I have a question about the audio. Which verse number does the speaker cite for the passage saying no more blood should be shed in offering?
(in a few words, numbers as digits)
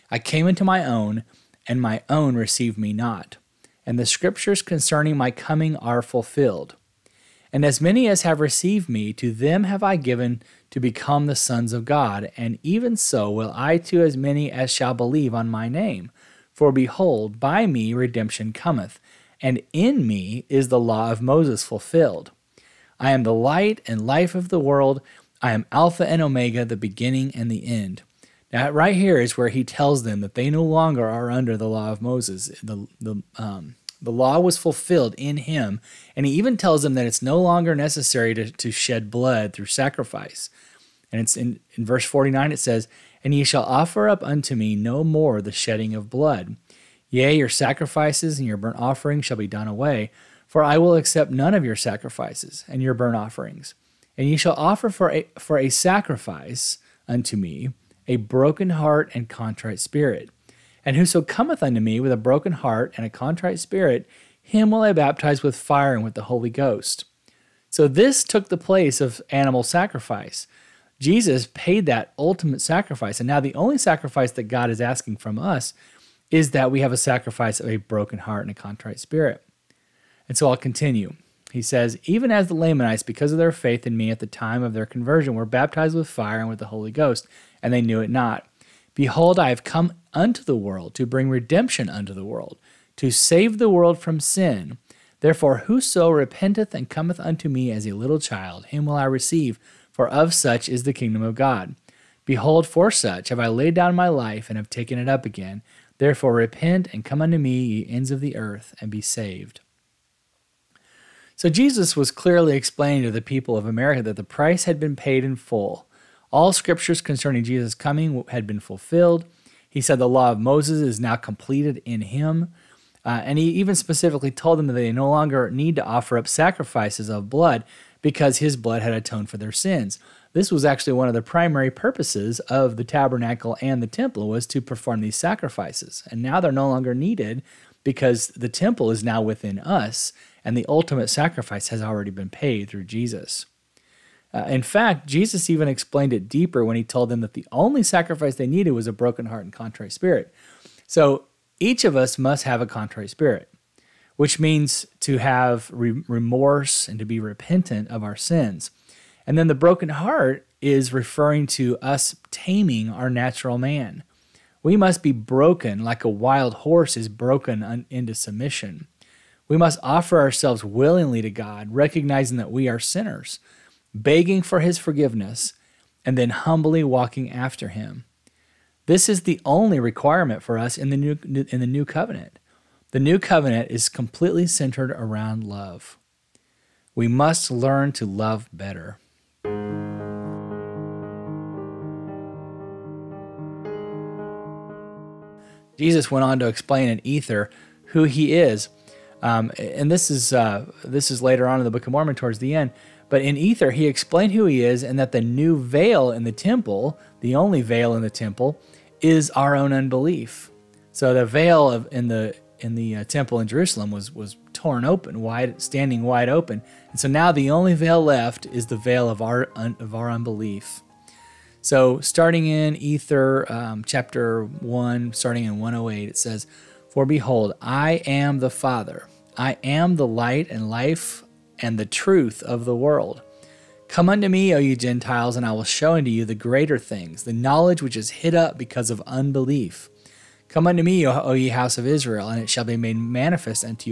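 49.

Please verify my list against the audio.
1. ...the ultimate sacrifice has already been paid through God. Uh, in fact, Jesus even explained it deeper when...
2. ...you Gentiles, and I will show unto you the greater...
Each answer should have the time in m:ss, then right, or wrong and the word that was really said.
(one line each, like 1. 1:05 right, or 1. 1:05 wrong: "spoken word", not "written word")
1. 2:20 wrong: "Jesus", not "God"
2. 3:54 right.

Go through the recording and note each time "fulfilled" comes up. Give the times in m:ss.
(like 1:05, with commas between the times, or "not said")
0:06, 0:21, 0:34, 1:58.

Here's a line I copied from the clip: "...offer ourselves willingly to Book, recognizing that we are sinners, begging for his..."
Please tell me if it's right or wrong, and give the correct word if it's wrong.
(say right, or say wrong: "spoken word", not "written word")
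wrong: "God", not "Book".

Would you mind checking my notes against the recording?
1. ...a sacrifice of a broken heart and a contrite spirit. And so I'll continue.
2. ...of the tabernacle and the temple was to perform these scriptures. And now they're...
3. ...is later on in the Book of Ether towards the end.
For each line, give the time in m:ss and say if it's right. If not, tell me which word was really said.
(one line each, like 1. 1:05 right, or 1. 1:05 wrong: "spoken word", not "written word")
1. 1:16 right
2. 2:12 wrong: "sacrifices", not "scriptures"
3. 3:21 wrong: "Mormon", not "Ether".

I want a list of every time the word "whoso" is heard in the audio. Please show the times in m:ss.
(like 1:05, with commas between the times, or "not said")
1:00, 1:35.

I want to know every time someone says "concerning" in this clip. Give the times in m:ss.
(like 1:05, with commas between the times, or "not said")
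0:04, 1:57.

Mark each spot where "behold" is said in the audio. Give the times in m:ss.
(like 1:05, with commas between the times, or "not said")
0:16, 1:28, 1:42, 3:47.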